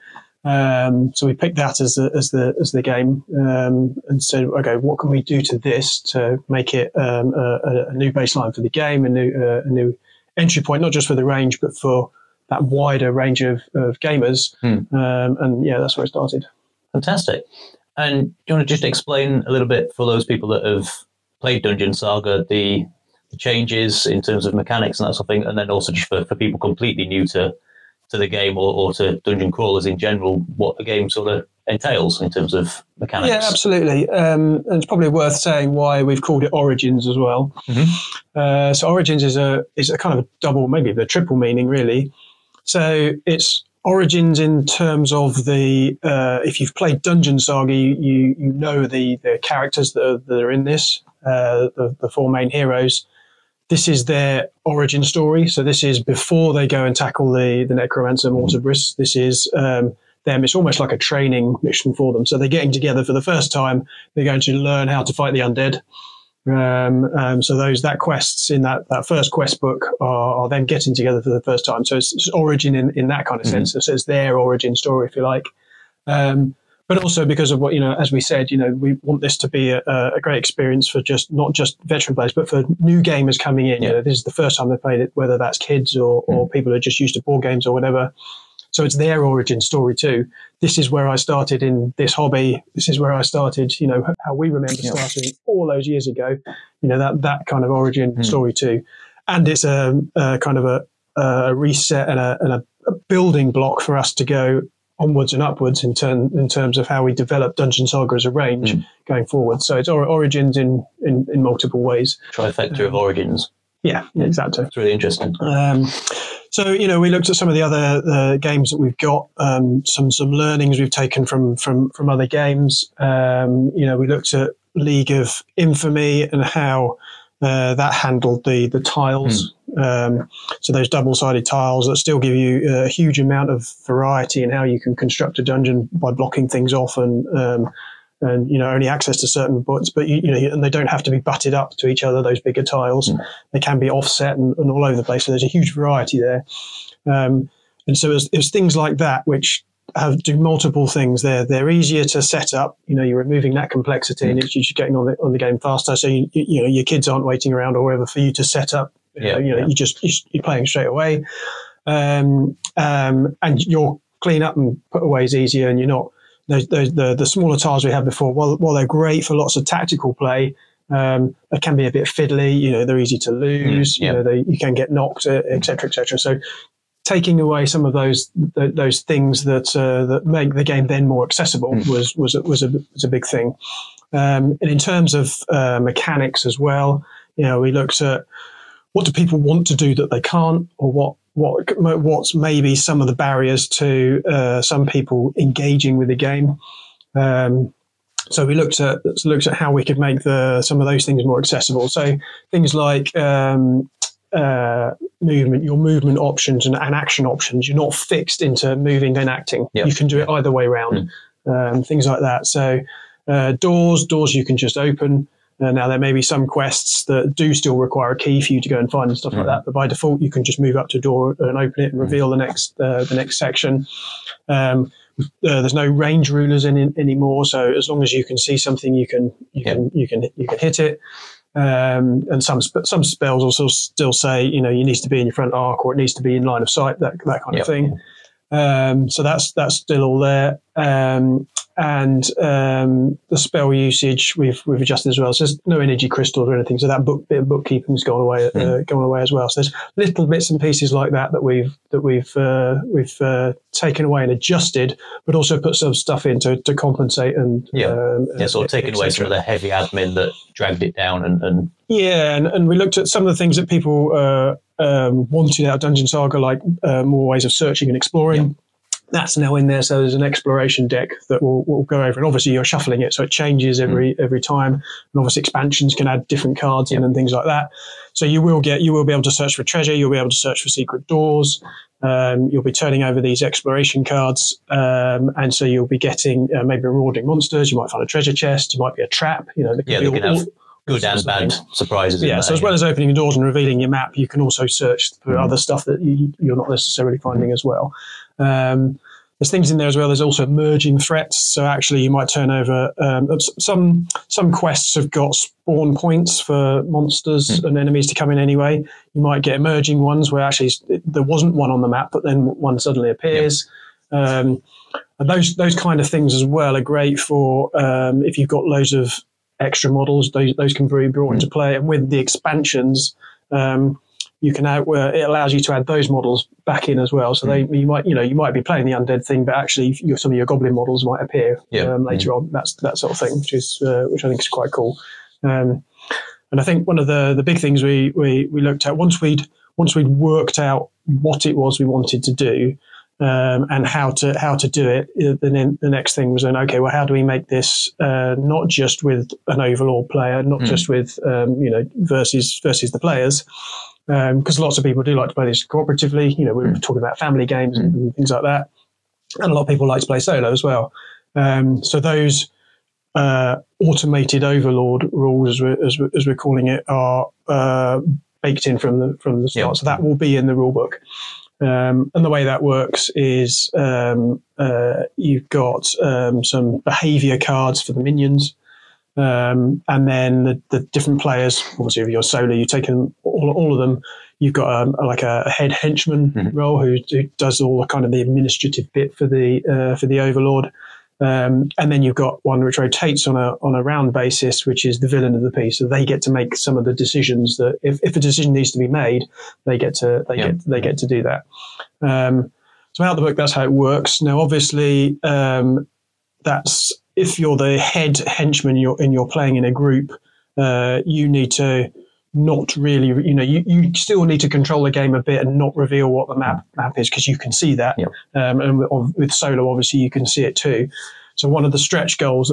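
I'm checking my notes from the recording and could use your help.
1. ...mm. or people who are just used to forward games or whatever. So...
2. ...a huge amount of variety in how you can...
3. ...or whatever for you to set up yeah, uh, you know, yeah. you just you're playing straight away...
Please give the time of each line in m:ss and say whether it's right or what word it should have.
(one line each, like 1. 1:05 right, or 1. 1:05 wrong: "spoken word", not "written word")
1. 1:26 wrong: "board", not "forward"
2. 2:12 right
3. 2:37 right.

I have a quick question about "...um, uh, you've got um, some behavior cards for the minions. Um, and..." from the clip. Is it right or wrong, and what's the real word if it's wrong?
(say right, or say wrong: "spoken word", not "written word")
right.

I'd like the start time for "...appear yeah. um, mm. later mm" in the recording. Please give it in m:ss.
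5:31.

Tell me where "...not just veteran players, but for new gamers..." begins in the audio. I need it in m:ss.
1:21.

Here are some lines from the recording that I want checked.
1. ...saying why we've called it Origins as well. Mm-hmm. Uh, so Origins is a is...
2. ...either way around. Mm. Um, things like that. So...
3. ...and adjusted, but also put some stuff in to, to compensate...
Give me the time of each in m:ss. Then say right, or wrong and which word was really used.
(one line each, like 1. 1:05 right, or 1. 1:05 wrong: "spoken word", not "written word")
1. 0:35 right
2. 3:30 right
3. 4:14 right.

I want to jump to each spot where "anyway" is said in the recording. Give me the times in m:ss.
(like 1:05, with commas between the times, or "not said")
5:08.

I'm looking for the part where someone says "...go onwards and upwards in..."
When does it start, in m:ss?
1:44.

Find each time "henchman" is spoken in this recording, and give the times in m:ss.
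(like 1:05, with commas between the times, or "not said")
6:25, 6:48.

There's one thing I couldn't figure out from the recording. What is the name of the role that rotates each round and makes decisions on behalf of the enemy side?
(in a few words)
villain of the piece.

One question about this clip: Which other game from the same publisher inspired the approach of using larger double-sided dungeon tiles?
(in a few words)
League of Infamy.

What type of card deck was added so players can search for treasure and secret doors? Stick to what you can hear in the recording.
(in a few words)
exploration deck.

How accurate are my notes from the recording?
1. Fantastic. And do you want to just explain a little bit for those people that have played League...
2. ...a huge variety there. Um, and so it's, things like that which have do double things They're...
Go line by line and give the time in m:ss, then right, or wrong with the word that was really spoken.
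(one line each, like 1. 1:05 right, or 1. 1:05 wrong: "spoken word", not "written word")
1. 0:16 wrong: "Dungeon", not "League"
2. 2:25 wrong: "multiple", not "double".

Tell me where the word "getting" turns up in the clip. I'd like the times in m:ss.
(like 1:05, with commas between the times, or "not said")
1:02, 1:10, 2:34, 4:45.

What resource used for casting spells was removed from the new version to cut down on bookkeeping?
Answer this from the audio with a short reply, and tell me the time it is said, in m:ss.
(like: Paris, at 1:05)
energy crystals, at 4:05.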